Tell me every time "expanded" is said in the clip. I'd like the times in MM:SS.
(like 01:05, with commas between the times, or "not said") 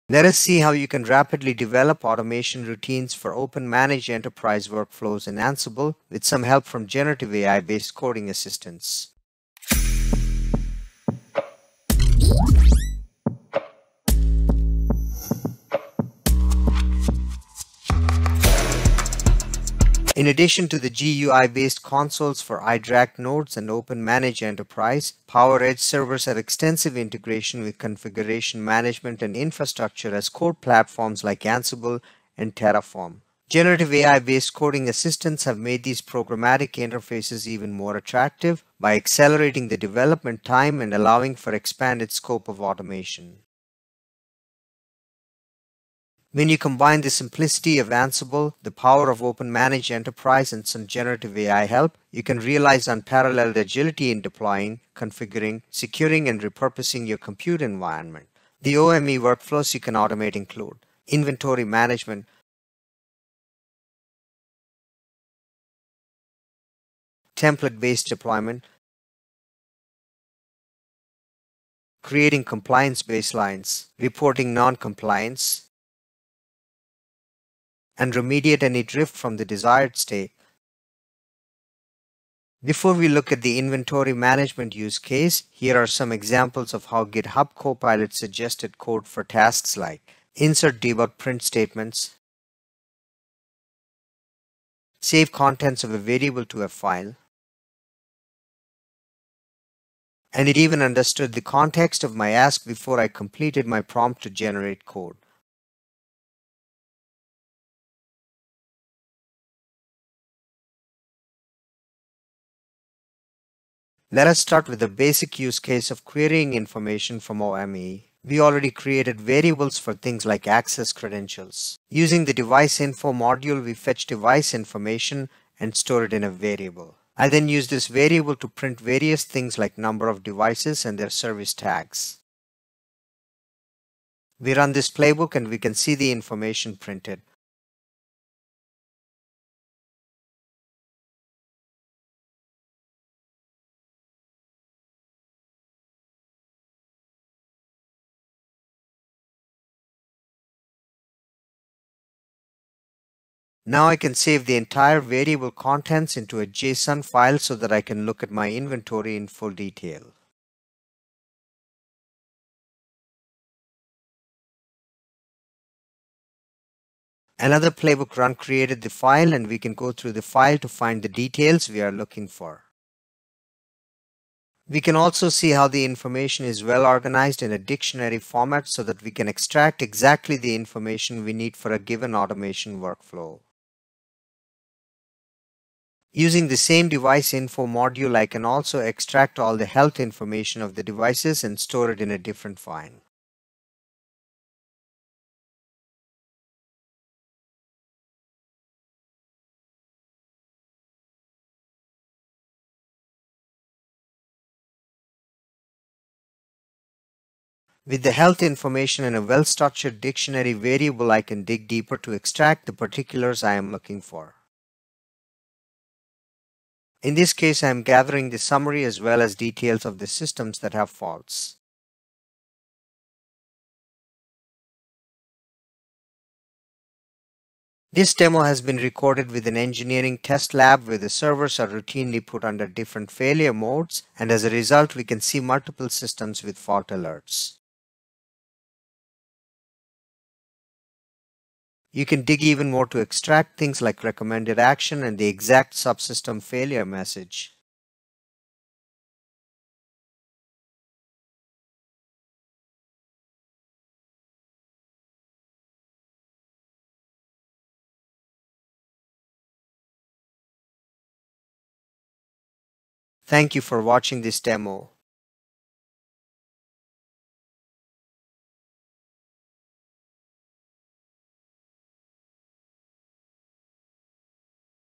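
00:41.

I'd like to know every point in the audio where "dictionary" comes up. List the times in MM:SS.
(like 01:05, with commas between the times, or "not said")
02:57, 03:30.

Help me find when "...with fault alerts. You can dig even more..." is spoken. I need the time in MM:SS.
03:56.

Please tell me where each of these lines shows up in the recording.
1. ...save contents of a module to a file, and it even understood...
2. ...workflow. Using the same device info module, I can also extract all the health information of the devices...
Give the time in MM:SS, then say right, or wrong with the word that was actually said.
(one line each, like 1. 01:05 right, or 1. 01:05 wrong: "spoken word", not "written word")
1. 01:34 wrong: "variable", not "module"
2. 03:02 right.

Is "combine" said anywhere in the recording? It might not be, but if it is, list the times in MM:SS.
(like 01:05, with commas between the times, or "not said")
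00:46.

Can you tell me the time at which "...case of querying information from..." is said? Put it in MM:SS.
01:55.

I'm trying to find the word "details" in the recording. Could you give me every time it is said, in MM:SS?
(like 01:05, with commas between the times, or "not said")
02:39, 02:51, 03:39.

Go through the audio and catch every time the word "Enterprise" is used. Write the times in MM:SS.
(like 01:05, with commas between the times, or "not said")
00:04, 00:24, 00:49.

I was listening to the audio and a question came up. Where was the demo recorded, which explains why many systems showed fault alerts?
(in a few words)
engineering test lab.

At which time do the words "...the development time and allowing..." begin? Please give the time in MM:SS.
00:39.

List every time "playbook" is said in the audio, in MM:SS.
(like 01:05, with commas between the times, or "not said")
02:14, 02:47.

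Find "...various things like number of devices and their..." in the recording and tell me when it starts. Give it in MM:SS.
02:08.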